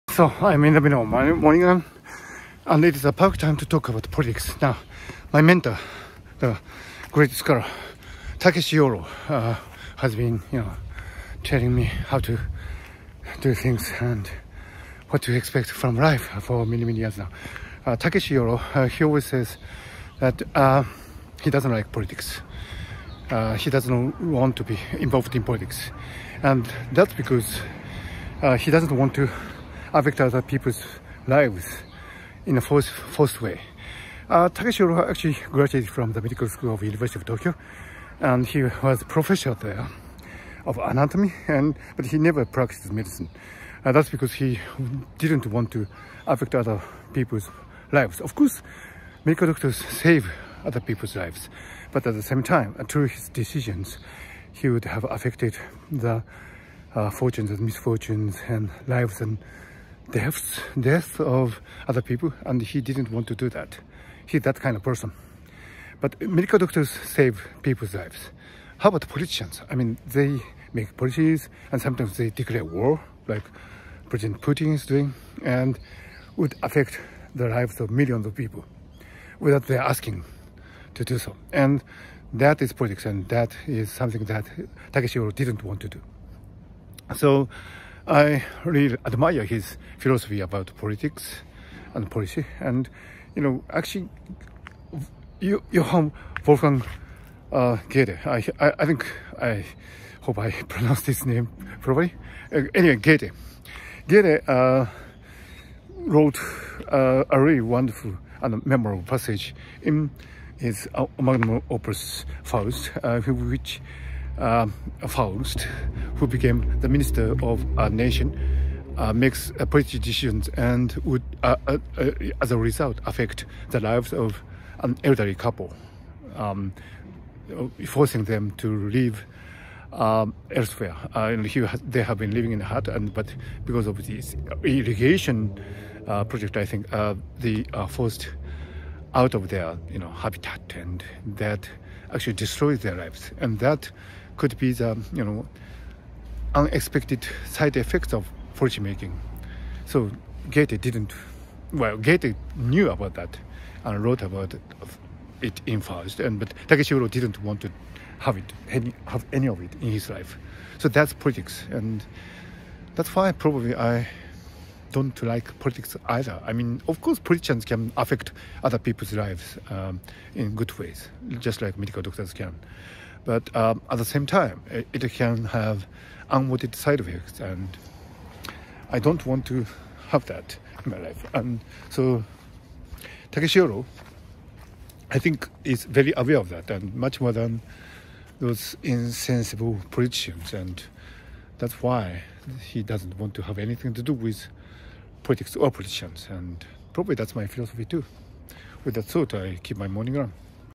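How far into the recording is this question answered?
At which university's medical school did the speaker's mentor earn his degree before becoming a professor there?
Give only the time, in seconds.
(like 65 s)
36 s.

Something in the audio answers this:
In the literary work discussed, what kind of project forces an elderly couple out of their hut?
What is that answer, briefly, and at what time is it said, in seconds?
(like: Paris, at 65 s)
Irrigation project, at 134 s.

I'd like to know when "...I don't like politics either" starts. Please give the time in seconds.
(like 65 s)
163 s.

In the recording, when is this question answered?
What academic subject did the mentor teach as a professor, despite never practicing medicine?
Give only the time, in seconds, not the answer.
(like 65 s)
40 s.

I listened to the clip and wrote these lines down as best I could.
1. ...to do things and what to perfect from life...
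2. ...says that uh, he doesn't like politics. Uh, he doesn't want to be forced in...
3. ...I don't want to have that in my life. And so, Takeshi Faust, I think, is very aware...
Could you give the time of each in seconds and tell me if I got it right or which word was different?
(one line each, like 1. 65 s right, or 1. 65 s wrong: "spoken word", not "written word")
1. 12 s wrong: "expect", not "perfect"
2. 19 s wrong: "involved", not "forced"
3. 178 s wrong: "Yoro", not "Faust".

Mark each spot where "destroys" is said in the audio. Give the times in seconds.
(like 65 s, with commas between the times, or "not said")
142 s.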